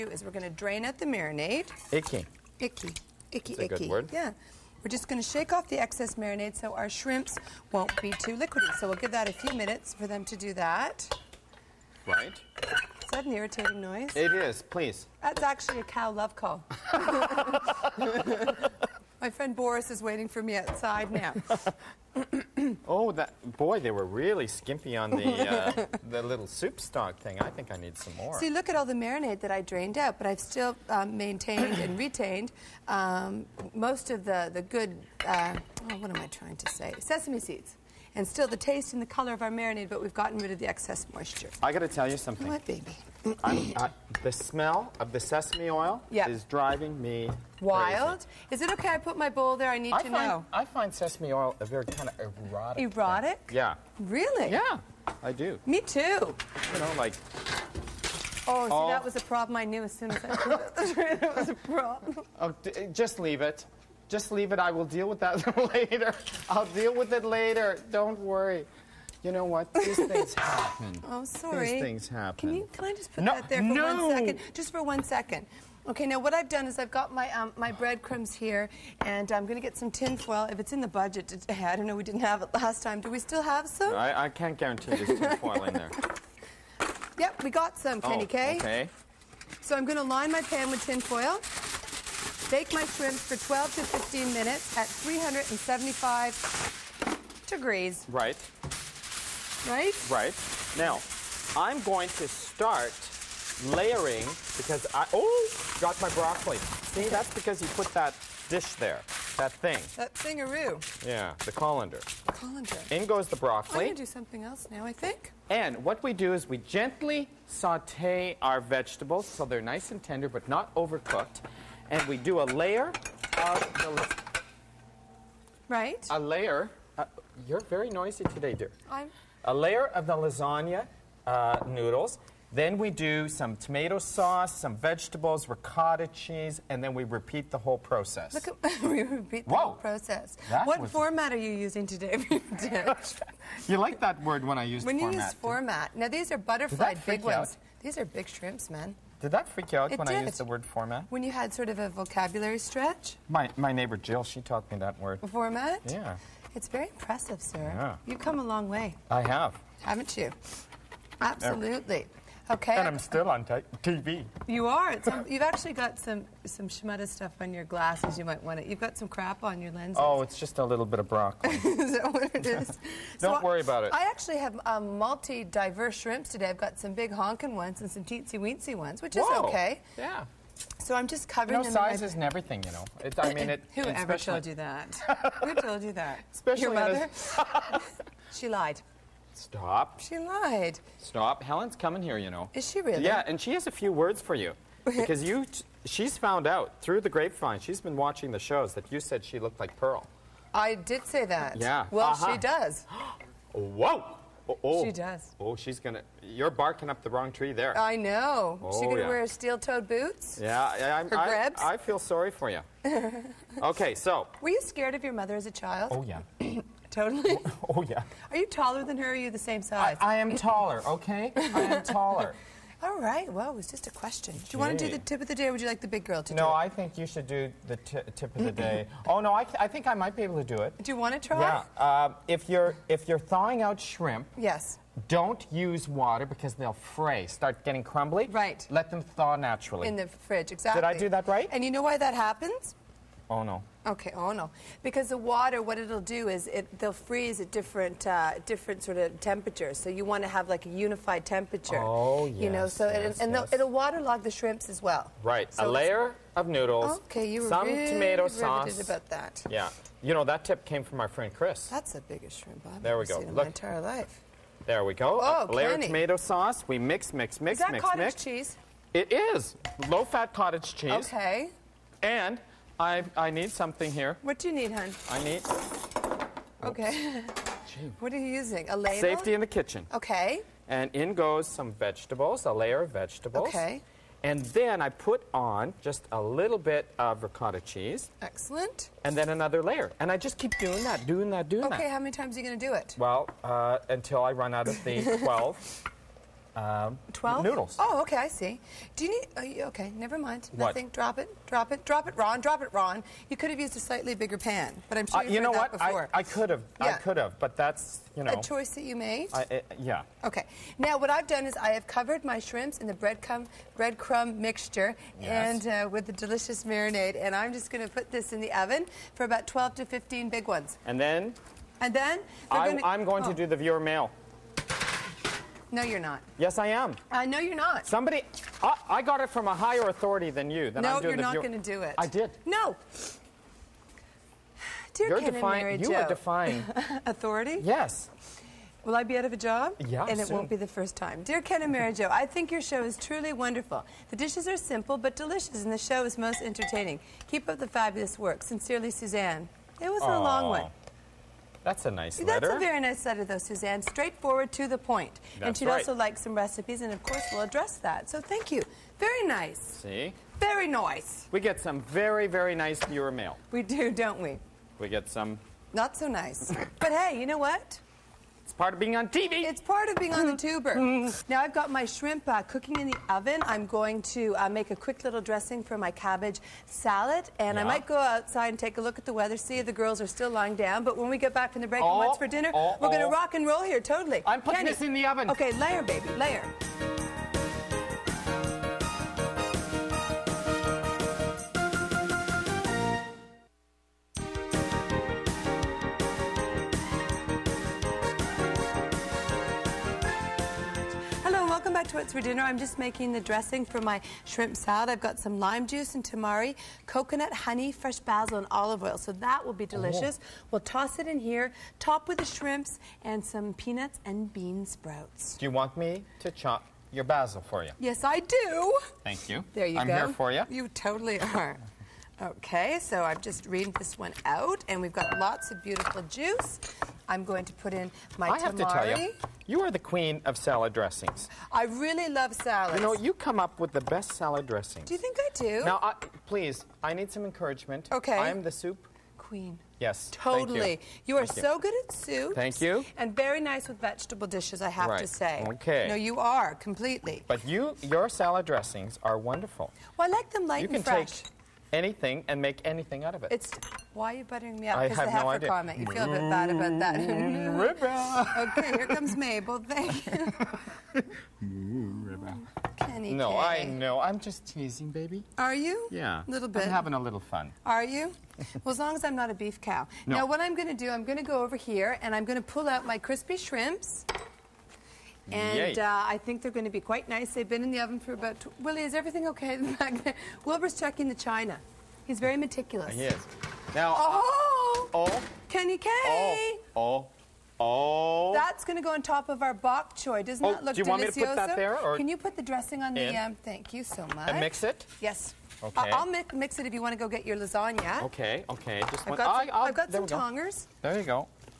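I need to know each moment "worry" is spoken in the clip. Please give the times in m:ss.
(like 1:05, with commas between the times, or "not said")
1:08, 2:53.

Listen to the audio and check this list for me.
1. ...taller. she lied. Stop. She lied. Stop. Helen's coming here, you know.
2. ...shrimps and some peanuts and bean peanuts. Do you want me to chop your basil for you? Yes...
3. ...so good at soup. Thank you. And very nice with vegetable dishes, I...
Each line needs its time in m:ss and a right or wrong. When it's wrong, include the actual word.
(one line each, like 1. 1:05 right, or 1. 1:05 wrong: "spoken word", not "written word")
1. 3:06 wrong: "mother", not "taller"
2. 6:52 wrong: "sprouts", not "peanuts"
3. 7:21 right.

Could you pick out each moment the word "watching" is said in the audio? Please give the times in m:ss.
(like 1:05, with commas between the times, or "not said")
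3:17.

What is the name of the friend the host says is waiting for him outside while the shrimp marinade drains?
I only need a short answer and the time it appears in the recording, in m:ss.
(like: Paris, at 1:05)
Boris, at 0:19.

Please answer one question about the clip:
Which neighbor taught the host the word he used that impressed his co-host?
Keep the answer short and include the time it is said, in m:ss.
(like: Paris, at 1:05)
Jill, at 2:33.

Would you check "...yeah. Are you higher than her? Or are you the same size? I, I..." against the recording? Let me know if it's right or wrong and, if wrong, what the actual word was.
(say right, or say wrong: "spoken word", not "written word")
wrong: "taller", not "higher".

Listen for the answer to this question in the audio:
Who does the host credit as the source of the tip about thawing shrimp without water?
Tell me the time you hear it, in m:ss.
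4:21.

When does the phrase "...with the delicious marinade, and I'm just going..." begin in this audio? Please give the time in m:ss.
5:15.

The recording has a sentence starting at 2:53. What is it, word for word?
I actually have um, multi-diverse shrimps today.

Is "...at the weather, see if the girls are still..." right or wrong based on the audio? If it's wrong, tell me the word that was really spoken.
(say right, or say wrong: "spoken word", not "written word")
right.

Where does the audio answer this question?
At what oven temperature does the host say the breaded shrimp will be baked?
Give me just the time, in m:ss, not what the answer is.
1:34.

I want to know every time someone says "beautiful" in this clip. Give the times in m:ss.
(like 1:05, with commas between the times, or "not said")
7:05.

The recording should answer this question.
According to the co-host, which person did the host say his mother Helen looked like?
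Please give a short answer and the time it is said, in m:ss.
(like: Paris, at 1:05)
Pearl, at 3:19.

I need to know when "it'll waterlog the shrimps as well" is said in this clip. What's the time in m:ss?
4:13.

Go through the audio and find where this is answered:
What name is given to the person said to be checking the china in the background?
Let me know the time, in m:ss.
8:00.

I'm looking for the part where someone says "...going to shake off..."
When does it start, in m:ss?
0:05.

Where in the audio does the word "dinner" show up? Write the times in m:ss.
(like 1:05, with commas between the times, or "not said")
6:22, 6:42.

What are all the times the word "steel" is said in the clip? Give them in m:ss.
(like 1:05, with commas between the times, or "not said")
3:29.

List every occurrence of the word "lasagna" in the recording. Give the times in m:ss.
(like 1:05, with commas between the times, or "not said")
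2:10, 8:17.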